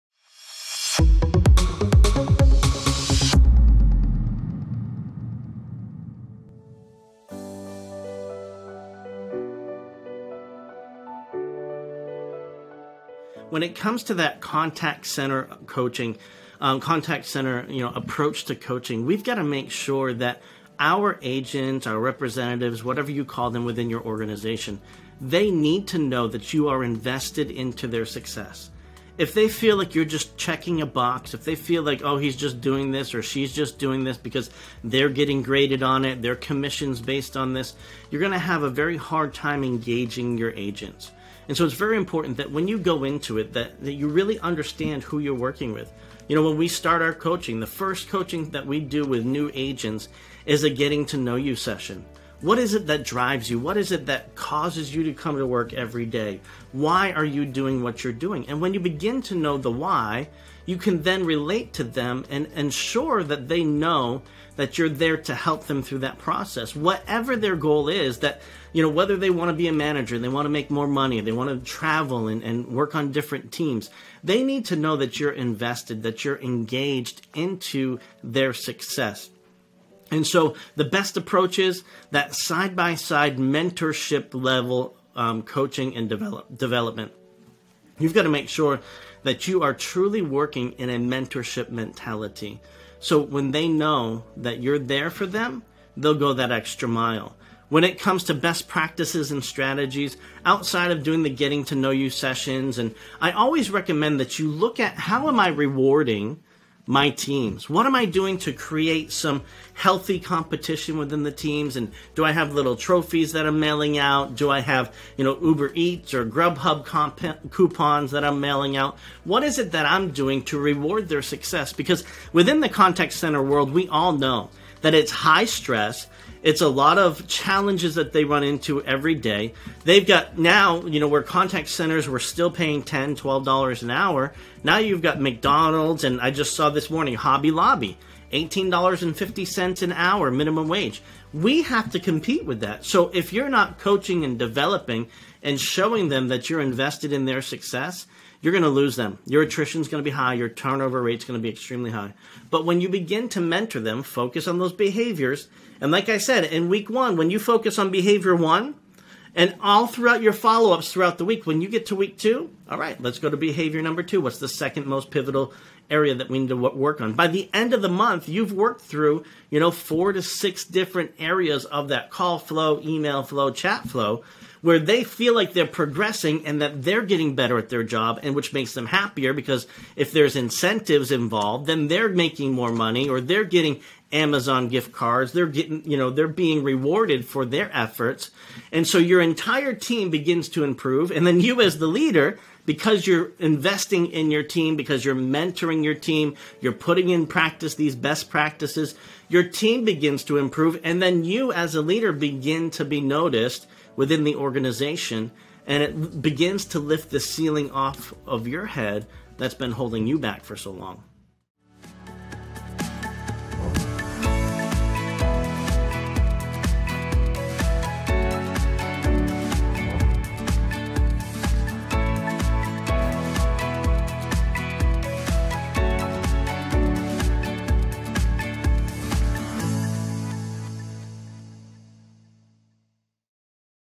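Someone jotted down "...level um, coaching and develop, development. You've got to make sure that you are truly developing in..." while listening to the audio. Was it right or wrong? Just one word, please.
wrong.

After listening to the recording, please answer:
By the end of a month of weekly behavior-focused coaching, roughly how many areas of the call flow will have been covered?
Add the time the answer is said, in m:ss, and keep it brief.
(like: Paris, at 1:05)
4 to 6, at 2:49.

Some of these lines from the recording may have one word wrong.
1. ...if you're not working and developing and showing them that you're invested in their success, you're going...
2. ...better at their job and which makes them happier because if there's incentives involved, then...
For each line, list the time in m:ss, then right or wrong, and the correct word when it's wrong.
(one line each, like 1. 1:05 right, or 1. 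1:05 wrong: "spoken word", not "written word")
1. 2:23 wrong: "coaching", not "working"
2. 2:57 right.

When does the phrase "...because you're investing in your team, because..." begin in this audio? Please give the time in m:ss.
3:12.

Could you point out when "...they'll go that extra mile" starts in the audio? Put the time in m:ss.
1:35.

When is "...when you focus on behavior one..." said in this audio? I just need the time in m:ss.
2:37.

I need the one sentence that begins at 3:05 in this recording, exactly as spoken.
They're getting, you know, they're being rewarded for their efforts.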